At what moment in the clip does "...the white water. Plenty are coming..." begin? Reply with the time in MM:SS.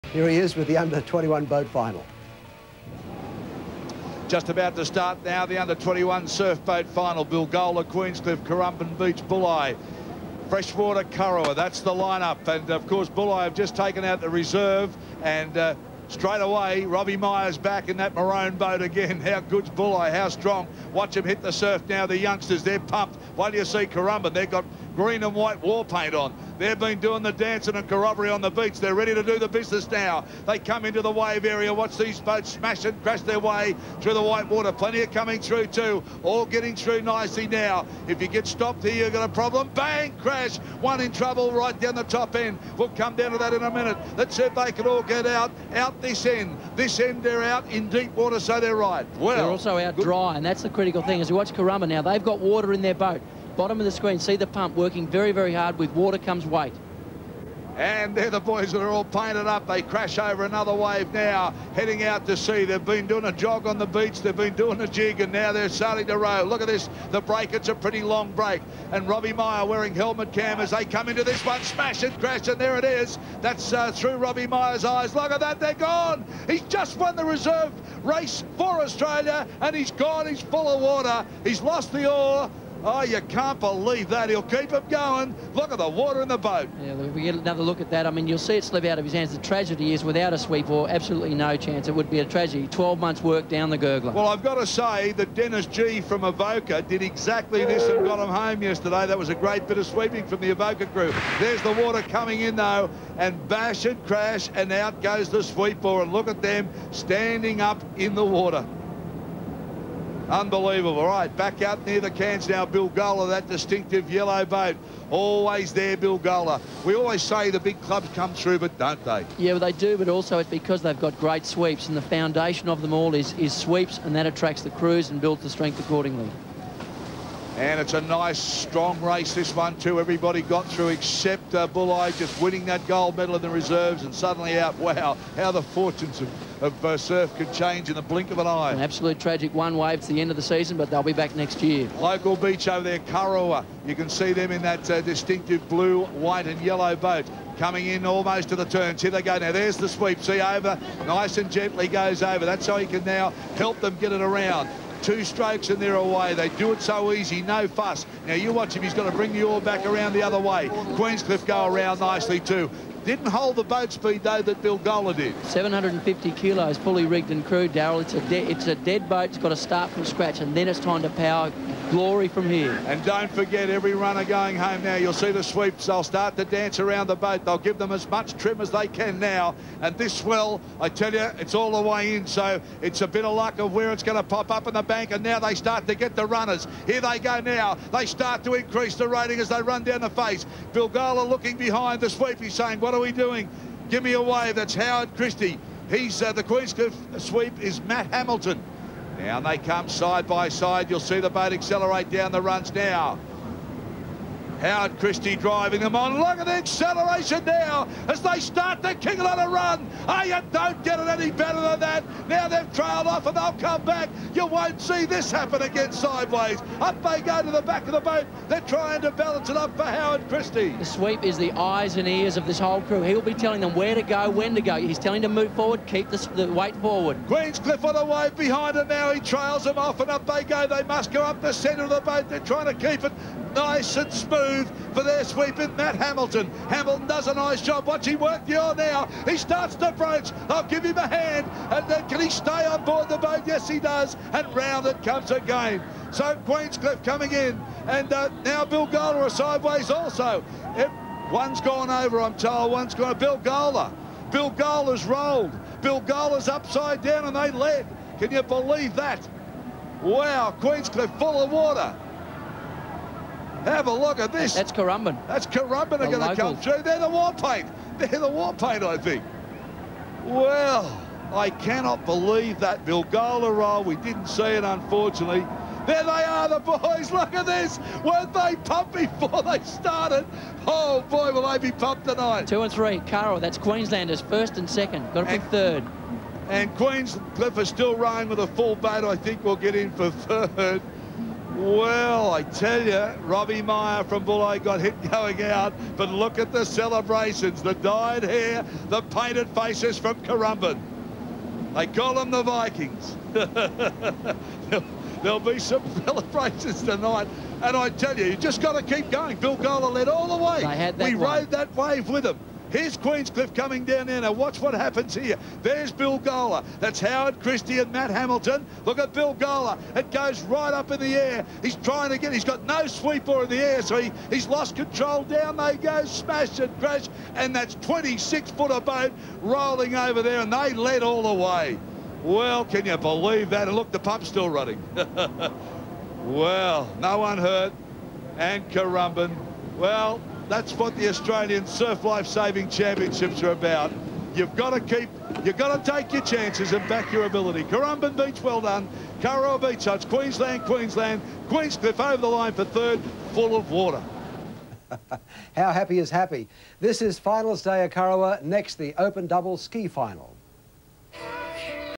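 00:34.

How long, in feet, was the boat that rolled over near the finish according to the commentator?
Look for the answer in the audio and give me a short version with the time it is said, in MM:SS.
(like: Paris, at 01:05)
26 foot, at 05:27.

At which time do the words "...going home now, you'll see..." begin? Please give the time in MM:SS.
02:54.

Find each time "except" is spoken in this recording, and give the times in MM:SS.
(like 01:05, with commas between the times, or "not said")
02:10.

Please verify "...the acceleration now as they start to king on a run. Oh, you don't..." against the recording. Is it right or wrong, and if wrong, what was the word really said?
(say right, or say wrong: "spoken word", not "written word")
right.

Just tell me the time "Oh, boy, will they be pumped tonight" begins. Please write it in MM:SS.
04:40.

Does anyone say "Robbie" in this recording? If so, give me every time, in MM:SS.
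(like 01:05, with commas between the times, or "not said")
00:16, 01:09, 01:14, 04:53.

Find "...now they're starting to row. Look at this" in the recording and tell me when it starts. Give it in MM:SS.
01:05.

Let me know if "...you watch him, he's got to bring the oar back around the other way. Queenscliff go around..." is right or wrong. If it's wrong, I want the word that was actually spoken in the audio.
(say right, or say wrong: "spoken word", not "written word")
right.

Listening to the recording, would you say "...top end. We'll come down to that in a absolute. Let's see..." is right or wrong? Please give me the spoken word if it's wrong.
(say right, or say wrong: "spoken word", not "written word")
wrong: "minute", not "absolute".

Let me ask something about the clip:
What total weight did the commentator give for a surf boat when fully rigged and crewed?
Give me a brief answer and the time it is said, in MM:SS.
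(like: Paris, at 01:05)
750 kilos, at 02:45.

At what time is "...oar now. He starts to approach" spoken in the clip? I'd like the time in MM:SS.
03:58.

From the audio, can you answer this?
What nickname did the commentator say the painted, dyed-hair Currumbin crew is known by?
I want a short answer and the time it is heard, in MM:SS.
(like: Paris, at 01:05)
The Vikings, at 05:01.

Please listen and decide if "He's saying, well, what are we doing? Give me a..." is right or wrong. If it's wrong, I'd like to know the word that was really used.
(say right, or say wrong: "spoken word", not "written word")
right.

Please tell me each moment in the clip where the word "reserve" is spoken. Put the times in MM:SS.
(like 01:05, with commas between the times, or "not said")
00:14, 01:17, 02:13.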